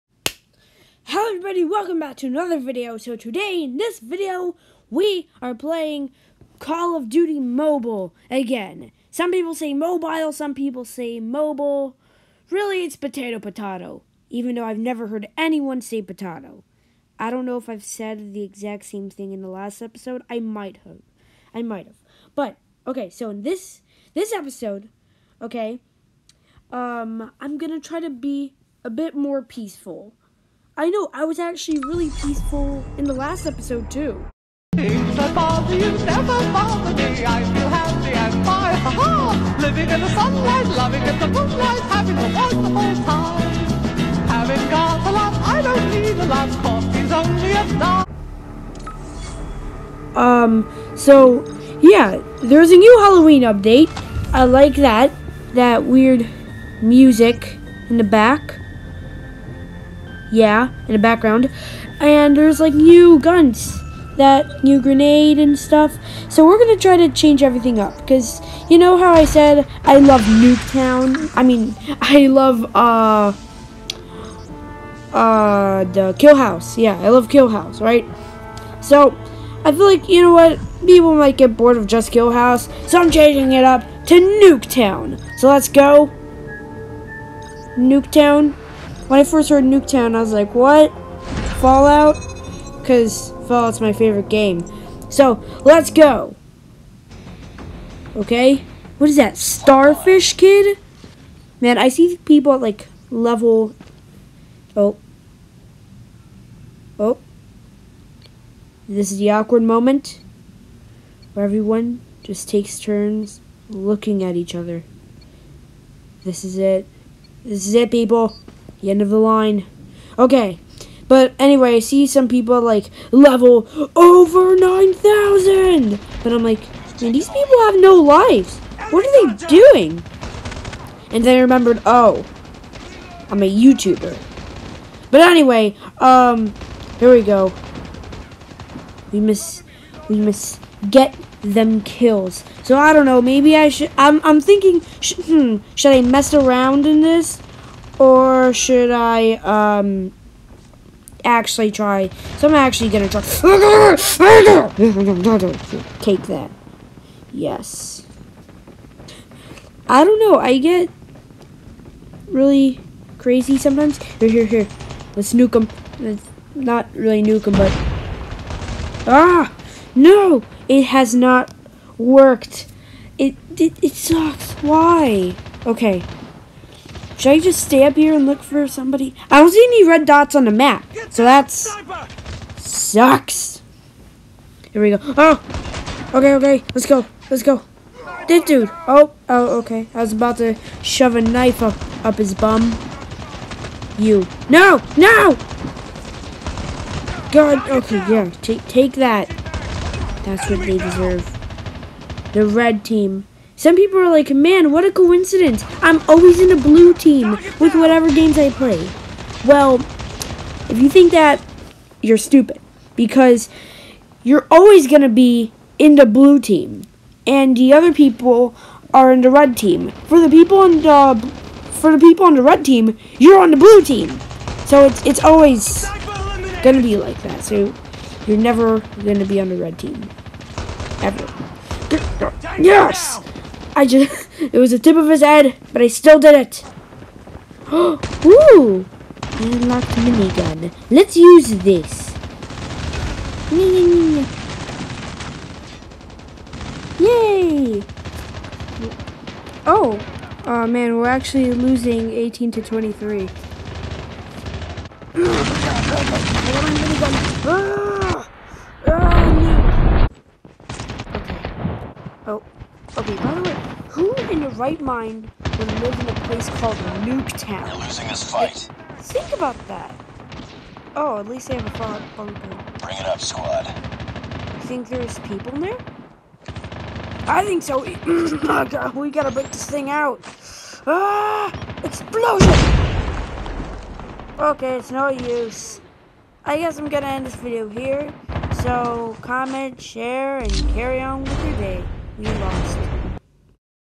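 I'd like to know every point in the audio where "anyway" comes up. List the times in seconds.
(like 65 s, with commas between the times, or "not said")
121 s, 135 s.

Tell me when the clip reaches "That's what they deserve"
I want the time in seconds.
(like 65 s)
200 s.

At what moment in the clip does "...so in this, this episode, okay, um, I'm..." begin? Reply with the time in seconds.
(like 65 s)
23 s.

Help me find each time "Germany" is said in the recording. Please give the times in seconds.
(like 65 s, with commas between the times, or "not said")
not said.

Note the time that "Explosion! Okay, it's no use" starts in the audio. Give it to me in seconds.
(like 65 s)
281 s.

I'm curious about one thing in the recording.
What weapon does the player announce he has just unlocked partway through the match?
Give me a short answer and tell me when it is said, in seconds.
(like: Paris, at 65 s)
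Minigun, at 239 s.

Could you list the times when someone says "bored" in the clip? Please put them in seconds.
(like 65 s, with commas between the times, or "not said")
81 s.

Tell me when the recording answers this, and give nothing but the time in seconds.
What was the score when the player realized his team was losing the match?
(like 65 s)
252 s.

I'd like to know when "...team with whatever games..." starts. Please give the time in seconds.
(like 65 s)
206 s.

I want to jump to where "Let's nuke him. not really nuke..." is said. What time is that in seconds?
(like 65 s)
165 s.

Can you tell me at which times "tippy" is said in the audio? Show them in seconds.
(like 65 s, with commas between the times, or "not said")
not said.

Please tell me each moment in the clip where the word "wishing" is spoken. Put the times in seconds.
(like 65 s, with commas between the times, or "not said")
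not said.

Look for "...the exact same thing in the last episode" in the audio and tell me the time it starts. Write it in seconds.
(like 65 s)
18 s.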